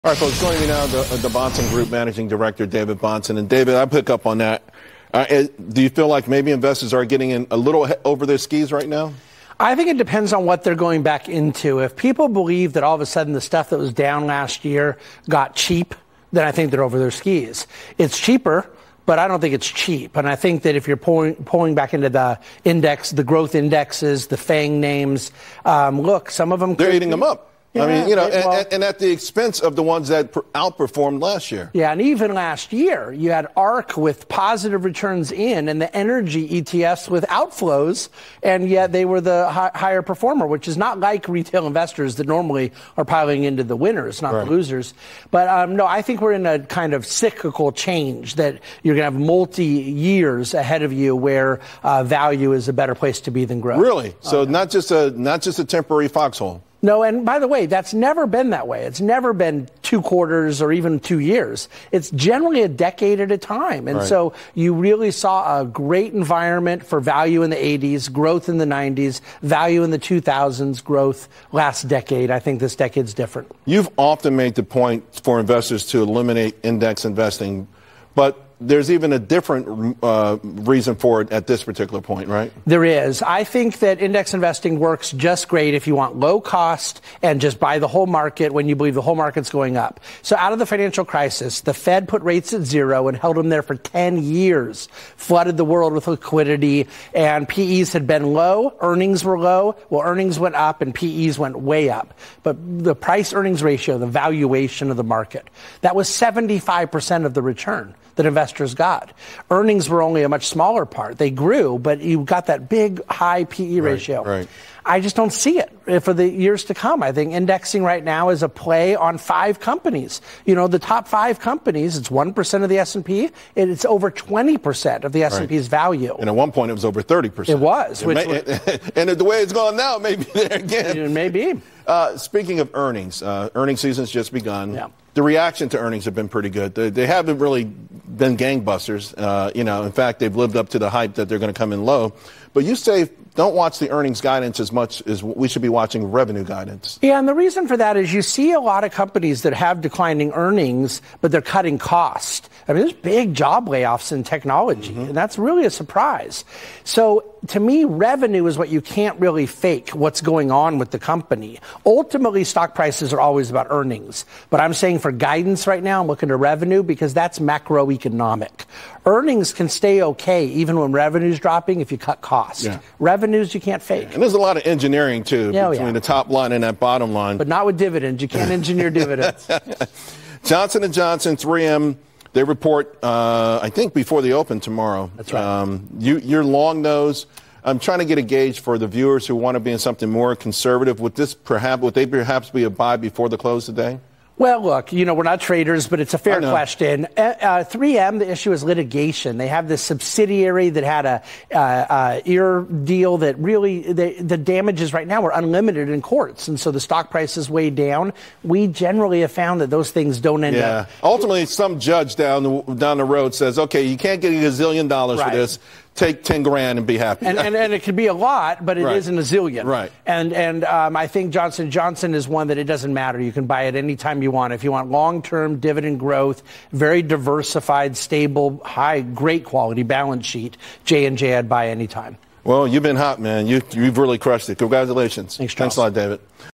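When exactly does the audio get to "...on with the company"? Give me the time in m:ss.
2:40.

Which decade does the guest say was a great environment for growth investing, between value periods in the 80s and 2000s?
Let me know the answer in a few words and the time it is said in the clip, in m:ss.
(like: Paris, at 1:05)
the 90s, at 1:08.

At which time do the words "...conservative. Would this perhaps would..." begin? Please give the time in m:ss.
3:10.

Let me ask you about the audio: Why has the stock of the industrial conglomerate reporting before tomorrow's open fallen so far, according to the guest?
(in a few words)
litigation.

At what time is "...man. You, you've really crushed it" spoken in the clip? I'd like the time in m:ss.
3:53.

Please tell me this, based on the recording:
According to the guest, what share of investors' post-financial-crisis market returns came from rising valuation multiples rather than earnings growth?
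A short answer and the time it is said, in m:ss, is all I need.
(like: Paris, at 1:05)
75%, at 1:46.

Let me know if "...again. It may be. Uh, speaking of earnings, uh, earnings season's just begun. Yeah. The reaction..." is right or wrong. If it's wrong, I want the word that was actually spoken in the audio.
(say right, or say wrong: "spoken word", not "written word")
right.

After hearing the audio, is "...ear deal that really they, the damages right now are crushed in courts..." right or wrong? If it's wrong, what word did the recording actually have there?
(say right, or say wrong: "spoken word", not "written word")
wrong: "unlimited", not "crushed".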